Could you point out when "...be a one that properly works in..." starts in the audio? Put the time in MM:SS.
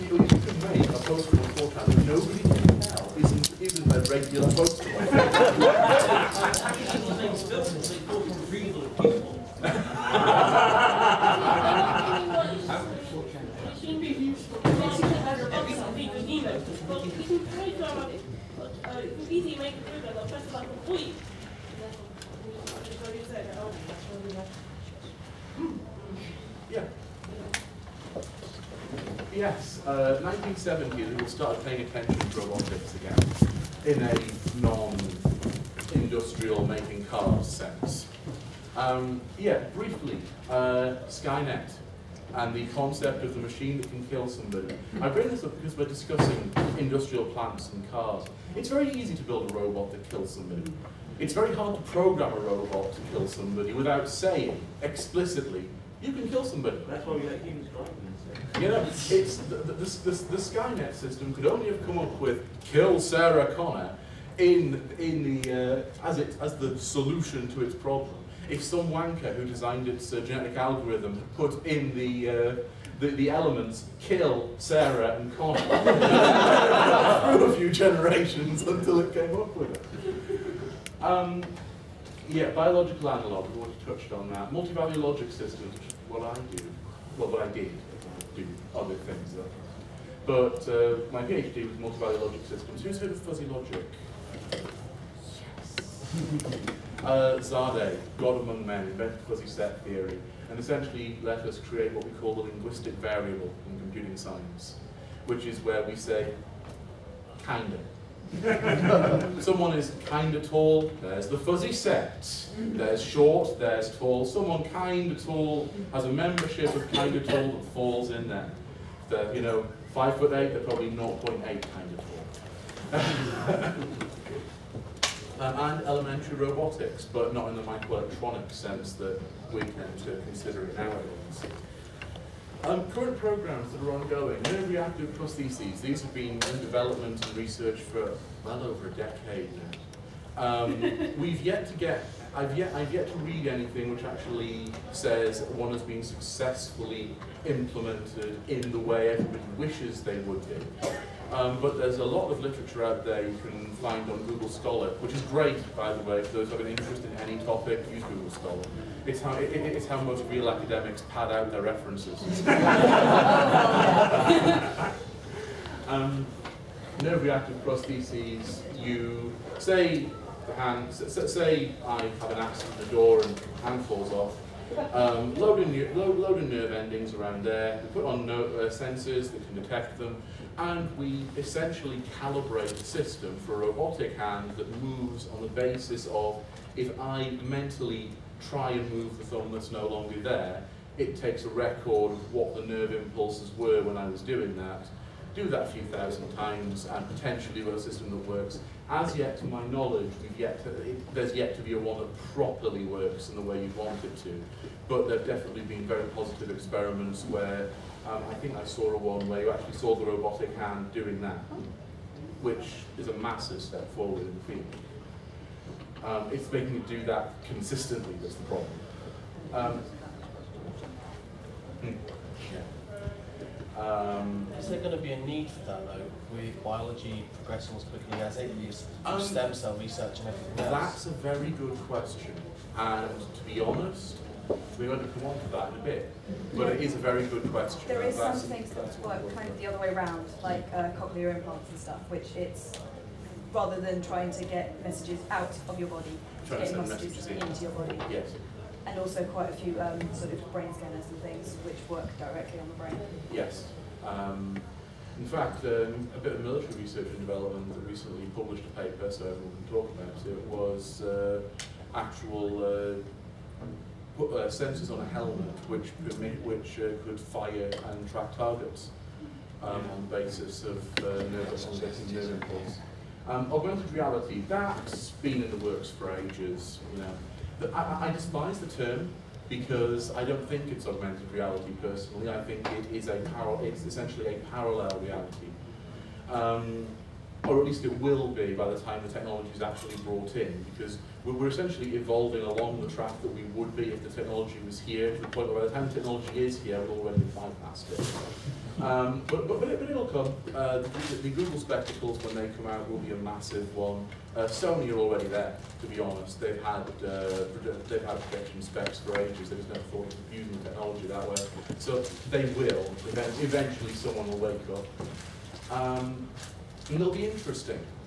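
03:21.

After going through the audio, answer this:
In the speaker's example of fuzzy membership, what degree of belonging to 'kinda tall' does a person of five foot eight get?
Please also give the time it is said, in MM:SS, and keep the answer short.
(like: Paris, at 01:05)
0.8, at 02:00.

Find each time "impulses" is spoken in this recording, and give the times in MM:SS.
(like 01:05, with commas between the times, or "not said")
03:12, 04:32.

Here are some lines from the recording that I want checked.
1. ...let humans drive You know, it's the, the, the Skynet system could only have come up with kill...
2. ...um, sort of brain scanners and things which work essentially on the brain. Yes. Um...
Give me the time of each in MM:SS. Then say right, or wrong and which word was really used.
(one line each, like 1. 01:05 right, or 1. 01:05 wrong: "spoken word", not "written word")
1. 00:57 right
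2. 04:09 wrong: "directly", not "essentially".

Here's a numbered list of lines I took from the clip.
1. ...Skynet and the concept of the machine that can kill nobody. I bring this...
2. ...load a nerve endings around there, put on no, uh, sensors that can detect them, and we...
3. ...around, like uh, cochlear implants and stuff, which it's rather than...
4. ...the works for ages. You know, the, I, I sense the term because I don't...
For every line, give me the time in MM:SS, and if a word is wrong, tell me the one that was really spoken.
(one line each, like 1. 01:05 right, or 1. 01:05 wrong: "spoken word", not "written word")
1. 00:41 wrong: "somebody", not "nobody"
2. 02:56 right
3. 03:59 right
4. 04:35 wrong: "despise", not "sense".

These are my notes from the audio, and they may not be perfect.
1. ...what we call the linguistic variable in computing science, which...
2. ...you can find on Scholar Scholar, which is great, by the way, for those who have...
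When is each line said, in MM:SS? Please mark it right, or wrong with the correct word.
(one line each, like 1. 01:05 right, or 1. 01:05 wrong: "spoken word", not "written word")
1. 01:41 right
2. 02:33 wrong: "Google", not "Scholar".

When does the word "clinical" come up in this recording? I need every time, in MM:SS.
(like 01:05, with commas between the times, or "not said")
not said.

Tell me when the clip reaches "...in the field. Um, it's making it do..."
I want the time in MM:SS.
03:34.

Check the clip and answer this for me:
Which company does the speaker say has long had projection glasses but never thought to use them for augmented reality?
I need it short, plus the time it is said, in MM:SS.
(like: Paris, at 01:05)
Sony, at 05:04.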